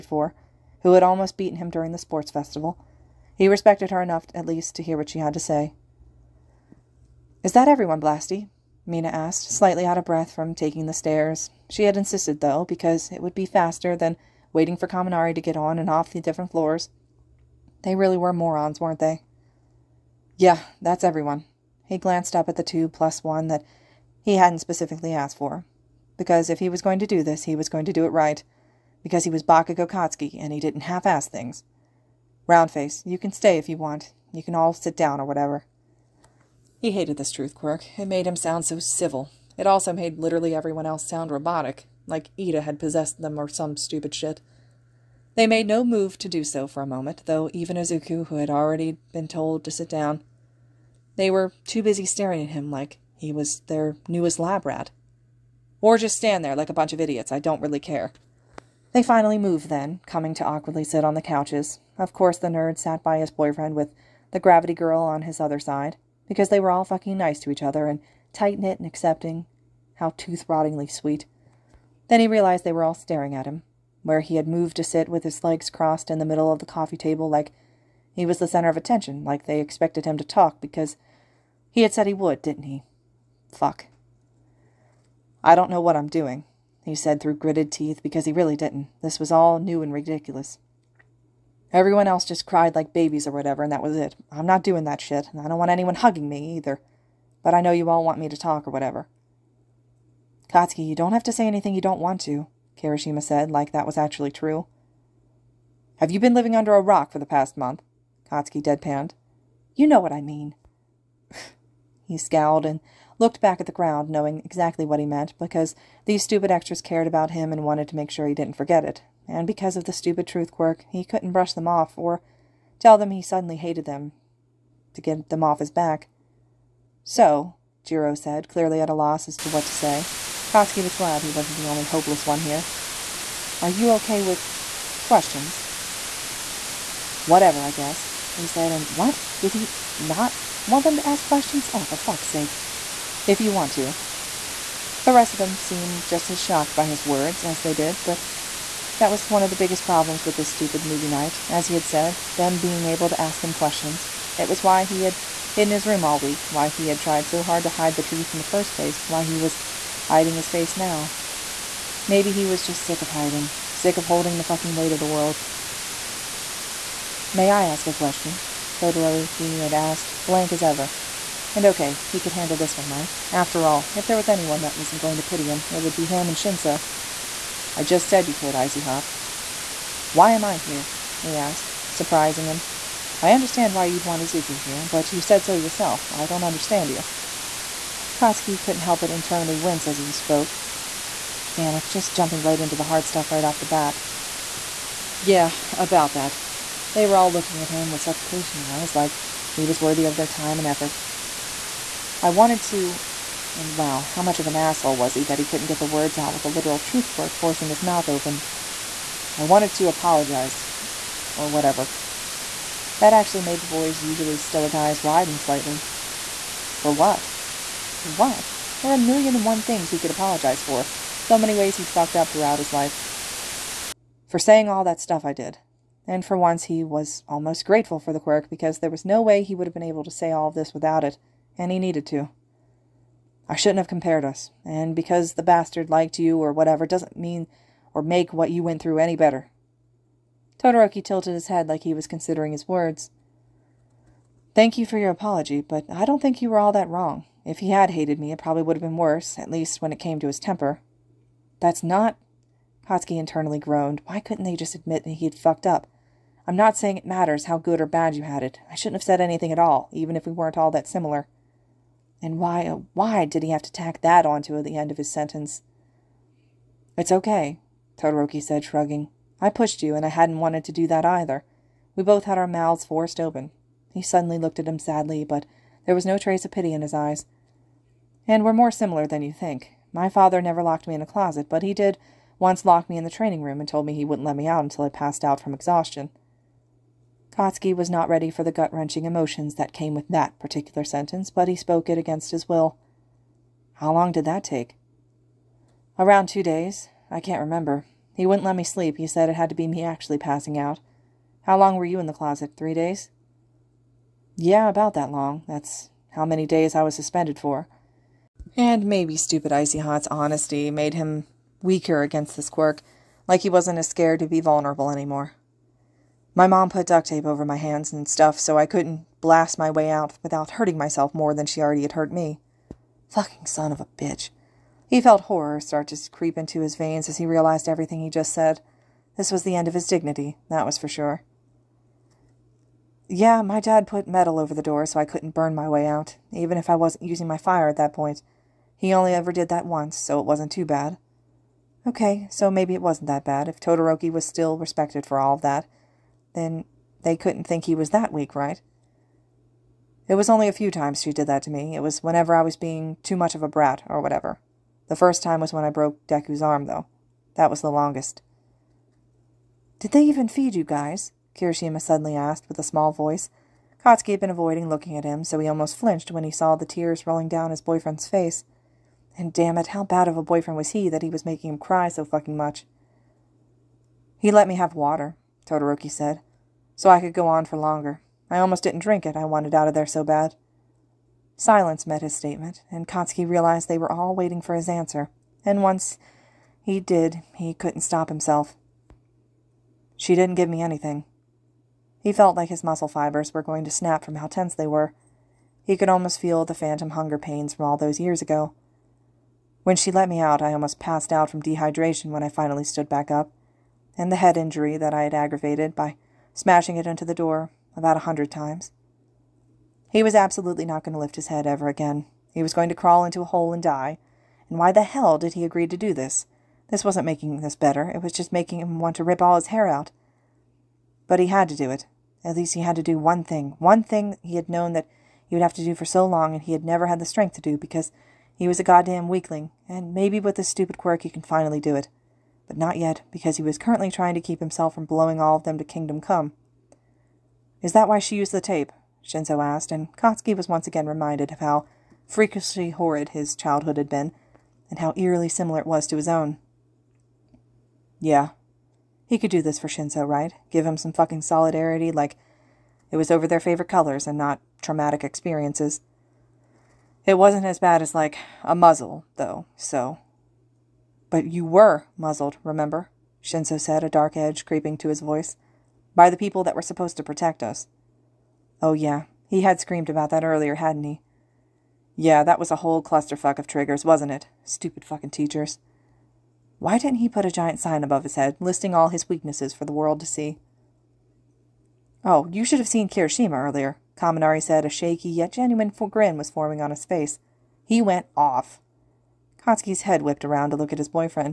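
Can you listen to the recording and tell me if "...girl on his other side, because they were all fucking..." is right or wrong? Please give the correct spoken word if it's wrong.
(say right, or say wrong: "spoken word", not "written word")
right.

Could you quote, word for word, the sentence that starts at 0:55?
Or just stand there like a bunch of idiots, I don't really care.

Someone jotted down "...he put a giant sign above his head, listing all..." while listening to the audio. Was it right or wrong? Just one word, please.
right.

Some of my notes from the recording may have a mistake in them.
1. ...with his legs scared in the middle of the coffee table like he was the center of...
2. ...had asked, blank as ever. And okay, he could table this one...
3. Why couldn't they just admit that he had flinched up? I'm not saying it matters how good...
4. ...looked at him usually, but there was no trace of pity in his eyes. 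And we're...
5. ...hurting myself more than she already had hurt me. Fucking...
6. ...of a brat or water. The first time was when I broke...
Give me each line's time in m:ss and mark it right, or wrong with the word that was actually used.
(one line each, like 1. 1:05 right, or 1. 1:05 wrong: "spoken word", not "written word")
1. 1:15 wrong: "crossed", not "scared"
2. 2:49 wrong: "handle", not "table"
3. 4:14 wrong: "fucked", not "flinched"
4. 4:34 wrong: "sadly", not "usually"
5. 5:20 right
6. 5:53 wrong: "whatever", not "water".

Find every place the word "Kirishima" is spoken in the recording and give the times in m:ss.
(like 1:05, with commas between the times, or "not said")
1:42, 6:01, 8:02.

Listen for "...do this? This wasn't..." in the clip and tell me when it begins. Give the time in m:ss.
6:55.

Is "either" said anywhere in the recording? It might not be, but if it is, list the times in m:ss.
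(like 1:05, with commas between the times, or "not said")
1:36, 4:31.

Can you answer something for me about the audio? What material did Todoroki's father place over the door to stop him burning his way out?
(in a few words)
Metal.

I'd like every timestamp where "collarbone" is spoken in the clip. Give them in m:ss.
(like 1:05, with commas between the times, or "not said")
not said.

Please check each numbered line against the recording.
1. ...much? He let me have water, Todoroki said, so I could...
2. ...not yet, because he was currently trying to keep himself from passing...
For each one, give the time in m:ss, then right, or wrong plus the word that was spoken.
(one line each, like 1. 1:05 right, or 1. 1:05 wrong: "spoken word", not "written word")
1. 6:12 right
2. 7:12 wrong: "blowing", not "passing".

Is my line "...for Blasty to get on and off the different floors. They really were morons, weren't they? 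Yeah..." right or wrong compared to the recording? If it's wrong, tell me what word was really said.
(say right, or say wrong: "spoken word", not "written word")
wrong: "Kaminari", not "Blasty".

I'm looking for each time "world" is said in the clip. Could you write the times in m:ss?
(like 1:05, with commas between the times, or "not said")
2:45, 7:59.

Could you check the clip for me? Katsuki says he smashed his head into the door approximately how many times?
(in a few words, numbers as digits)
About 100.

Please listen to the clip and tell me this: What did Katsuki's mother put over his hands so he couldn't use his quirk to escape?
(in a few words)
Duct tape.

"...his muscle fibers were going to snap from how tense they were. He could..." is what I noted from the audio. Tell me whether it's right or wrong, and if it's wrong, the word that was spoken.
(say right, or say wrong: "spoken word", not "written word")
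right.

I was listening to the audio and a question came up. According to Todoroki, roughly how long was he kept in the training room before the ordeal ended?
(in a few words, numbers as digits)
Around two days.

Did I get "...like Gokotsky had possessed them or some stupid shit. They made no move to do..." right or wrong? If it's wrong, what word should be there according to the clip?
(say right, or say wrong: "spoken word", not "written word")
wrong: "Iida", not "Gokotsky".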